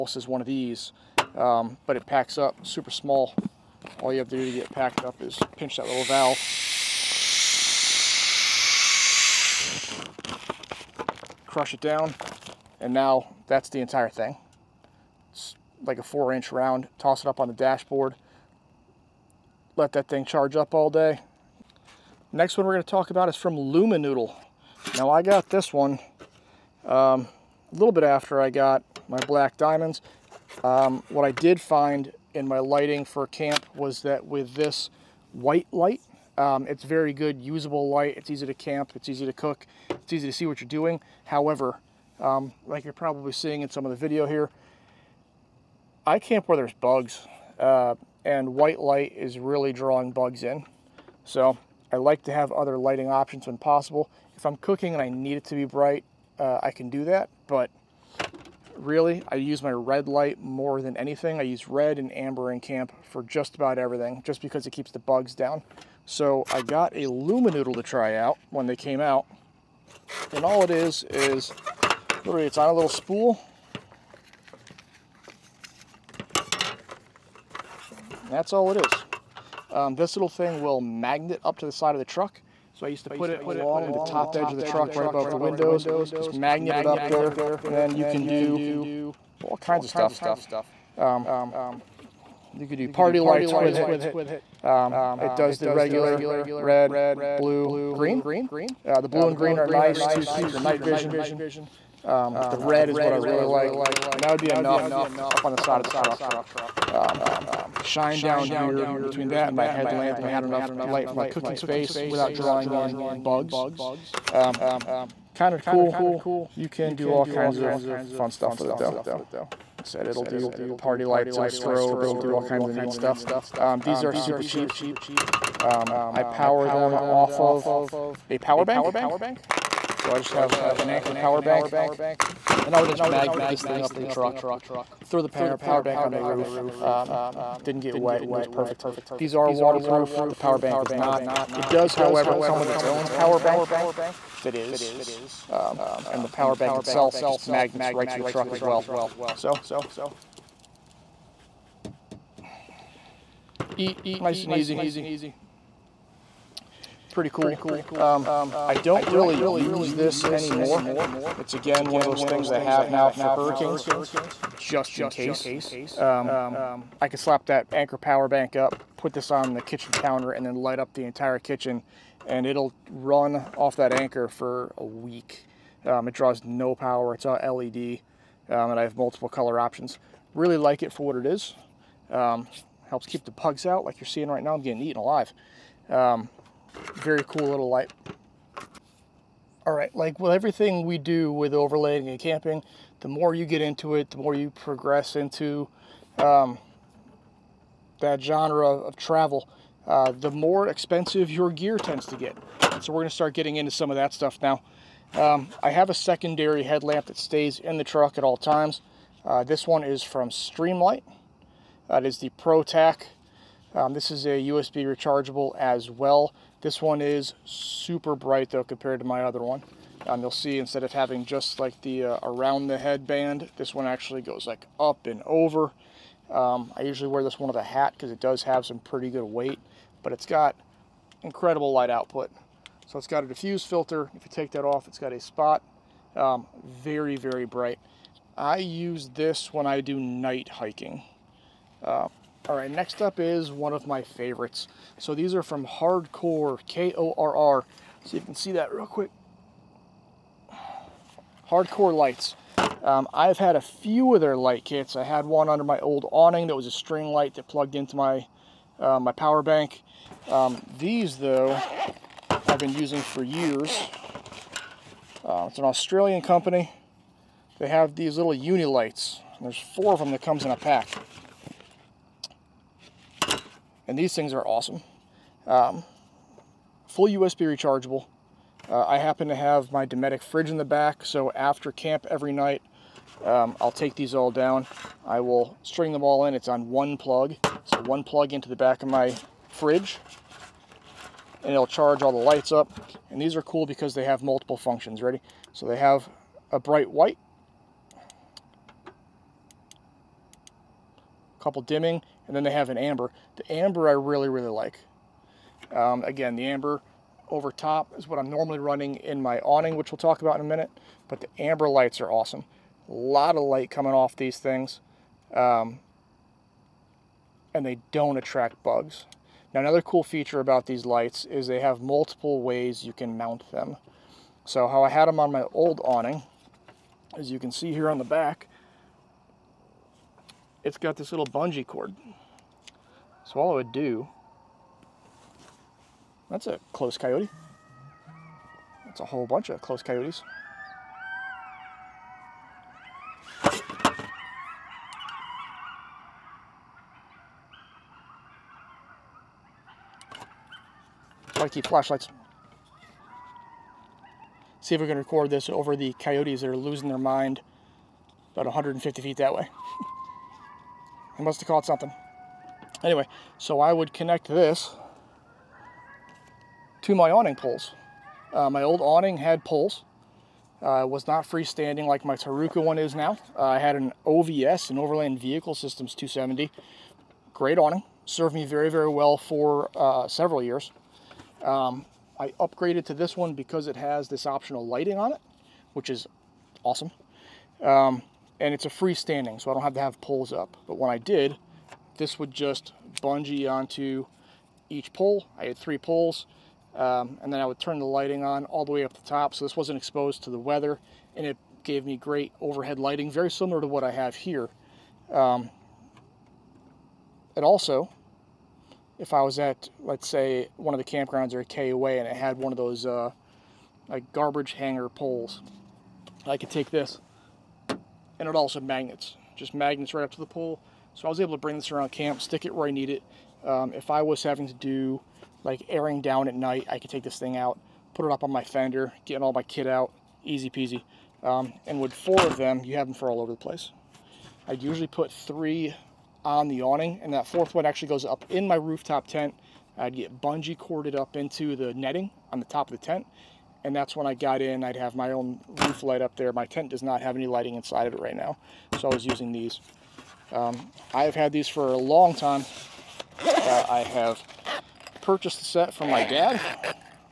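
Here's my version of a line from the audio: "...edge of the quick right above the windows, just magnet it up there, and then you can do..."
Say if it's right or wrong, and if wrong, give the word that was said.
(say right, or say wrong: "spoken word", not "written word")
wrong: "truck", not "quick".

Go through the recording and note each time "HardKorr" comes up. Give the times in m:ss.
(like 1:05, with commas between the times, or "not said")
4:05, 4:11.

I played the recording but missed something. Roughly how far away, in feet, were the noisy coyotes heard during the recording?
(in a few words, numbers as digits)
150 feet.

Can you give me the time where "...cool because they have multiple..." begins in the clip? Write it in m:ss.
4:53.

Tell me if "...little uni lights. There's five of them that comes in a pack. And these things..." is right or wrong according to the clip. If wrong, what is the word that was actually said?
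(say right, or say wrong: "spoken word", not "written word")
wrong: "four", not "five".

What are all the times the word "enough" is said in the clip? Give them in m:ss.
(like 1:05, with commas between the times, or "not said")
1:44, 1:50.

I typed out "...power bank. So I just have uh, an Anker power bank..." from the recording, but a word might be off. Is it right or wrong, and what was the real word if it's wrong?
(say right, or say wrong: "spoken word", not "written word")
right.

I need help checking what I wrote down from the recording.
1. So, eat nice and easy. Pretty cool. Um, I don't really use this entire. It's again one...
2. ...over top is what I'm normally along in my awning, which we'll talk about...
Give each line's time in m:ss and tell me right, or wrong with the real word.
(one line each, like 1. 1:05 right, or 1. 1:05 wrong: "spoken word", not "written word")
1. 2:29 wrong: "anymore", not "entire"
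2. 5:07 wrong: "running", not "along".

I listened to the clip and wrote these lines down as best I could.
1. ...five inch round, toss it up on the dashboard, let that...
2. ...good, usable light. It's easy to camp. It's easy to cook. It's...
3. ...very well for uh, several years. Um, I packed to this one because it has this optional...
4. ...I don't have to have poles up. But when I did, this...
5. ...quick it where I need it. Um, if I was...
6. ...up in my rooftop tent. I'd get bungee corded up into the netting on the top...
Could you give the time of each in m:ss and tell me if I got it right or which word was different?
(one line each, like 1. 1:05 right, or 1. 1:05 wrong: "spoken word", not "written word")
1. 0:16 wrong: "four", not "five"
2. 0:37 right
3. 6:18 wrong: "upgraded", not "packed"
4. 6:29 right
5. 7:02 wrong: "stick", not "quick"
6. 7:18 right.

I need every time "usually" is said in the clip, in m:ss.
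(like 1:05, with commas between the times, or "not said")
3:46, 7:14.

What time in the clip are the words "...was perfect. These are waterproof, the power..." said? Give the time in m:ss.
2:18.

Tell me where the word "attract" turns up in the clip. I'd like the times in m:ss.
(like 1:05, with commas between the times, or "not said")
5:18.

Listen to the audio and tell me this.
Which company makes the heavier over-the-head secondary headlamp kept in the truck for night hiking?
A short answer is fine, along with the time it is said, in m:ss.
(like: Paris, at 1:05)
Streamlight, at 3:30.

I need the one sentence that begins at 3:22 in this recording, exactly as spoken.
So we're going to start getting into some of that stuff now.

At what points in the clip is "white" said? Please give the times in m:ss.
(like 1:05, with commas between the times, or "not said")
0:35, 0:48, 4:56.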